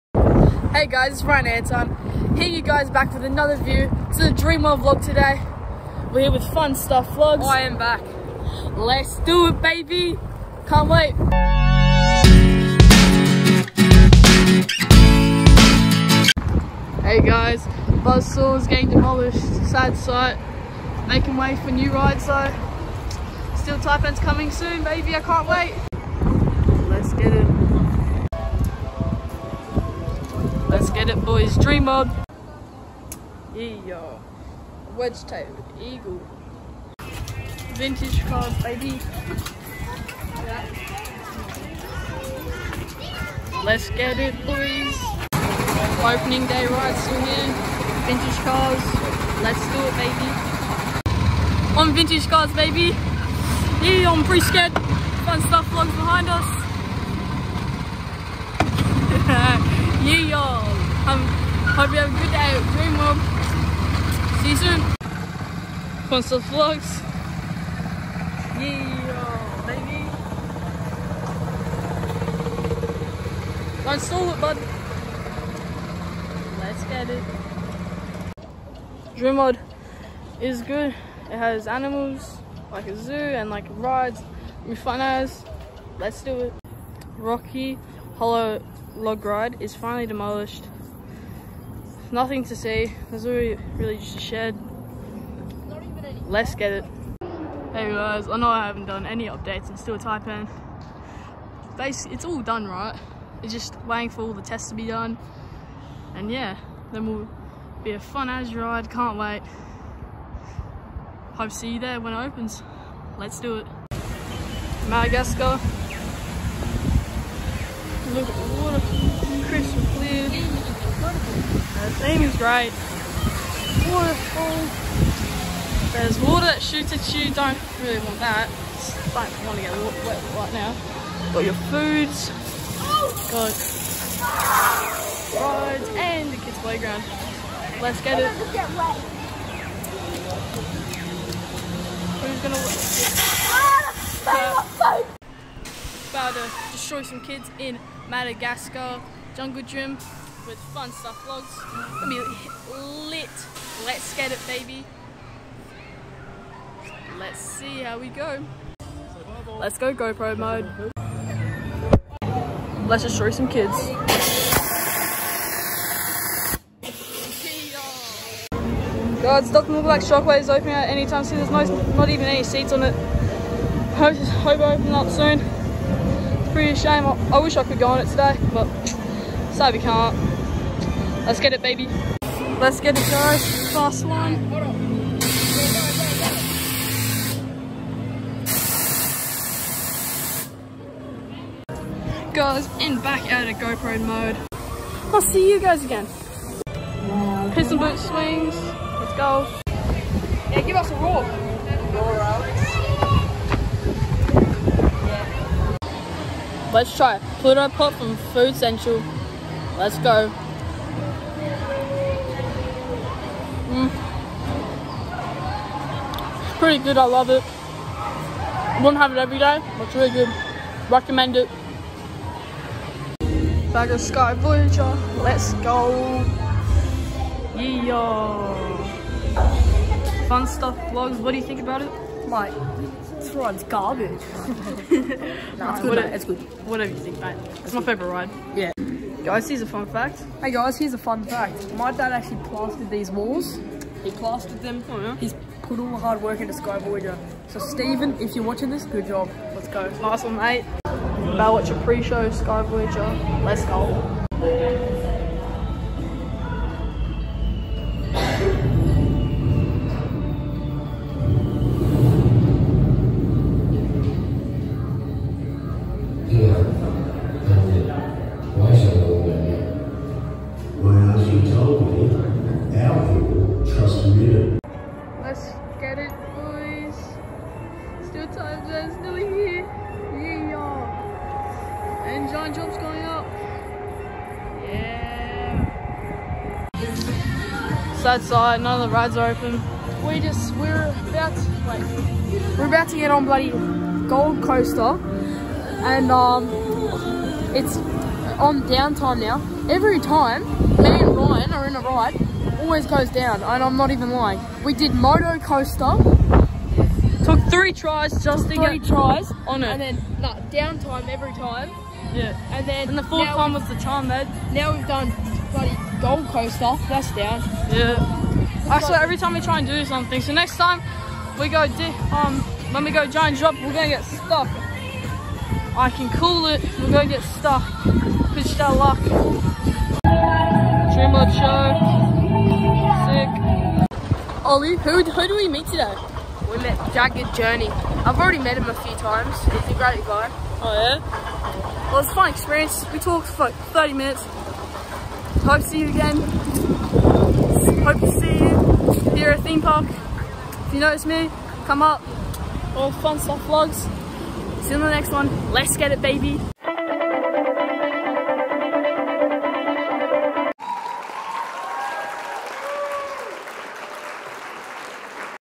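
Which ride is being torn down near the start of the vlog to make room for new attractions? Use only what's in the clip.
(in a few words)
Buzzsaw.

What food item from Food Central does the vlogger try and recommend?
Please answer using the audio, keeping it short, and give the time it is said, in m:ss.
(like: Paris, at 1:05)
Pluto Pop, at 3:27.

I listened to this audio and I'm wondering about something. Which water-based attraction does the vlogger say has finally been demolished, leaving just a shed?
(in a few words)
Rocky Hollow Log Ride.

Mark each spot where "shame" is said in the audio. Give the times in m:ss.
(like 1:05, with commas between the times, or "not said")
2:56.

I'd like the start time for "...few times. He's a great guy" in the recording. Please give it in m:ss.
5:38.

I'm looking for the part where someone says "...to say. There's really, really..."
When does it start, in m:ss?
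1:32.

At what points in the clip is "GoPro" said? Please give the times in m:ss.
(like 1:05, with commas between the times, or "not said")
2:39, 3:13.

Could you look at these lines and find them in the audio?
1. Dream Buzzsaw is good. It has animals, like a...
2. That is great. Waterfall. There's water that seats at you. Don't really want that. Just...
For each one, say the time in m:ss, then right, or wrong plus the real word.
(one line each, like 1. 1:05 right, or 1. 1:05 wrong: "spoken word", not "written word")
1. 1:19 wrong: "World", not "Buzzsaw"
2. 2:01 wrong: "shoots", not "seats".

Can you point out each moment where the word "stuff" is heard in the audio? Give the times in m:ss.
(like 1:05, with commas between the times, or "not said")
0:06, 0:55, 2:30, 3:50, 5:53.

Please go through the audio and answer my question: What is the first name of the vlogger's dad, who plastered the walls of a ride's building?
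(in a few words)
Stephen.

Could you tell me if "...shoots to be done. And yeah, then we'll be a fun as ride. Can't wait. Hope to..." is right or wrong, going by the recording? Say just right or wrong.
wrong.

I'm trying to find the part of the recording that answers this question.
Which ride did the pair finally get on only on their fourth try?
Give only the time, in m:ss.
5:04.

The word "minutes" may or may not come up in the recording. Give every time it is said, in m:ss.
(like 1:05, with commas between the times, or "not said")
5:43.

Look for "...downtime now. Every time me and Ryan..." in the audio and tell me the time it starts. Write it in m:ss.
4:58.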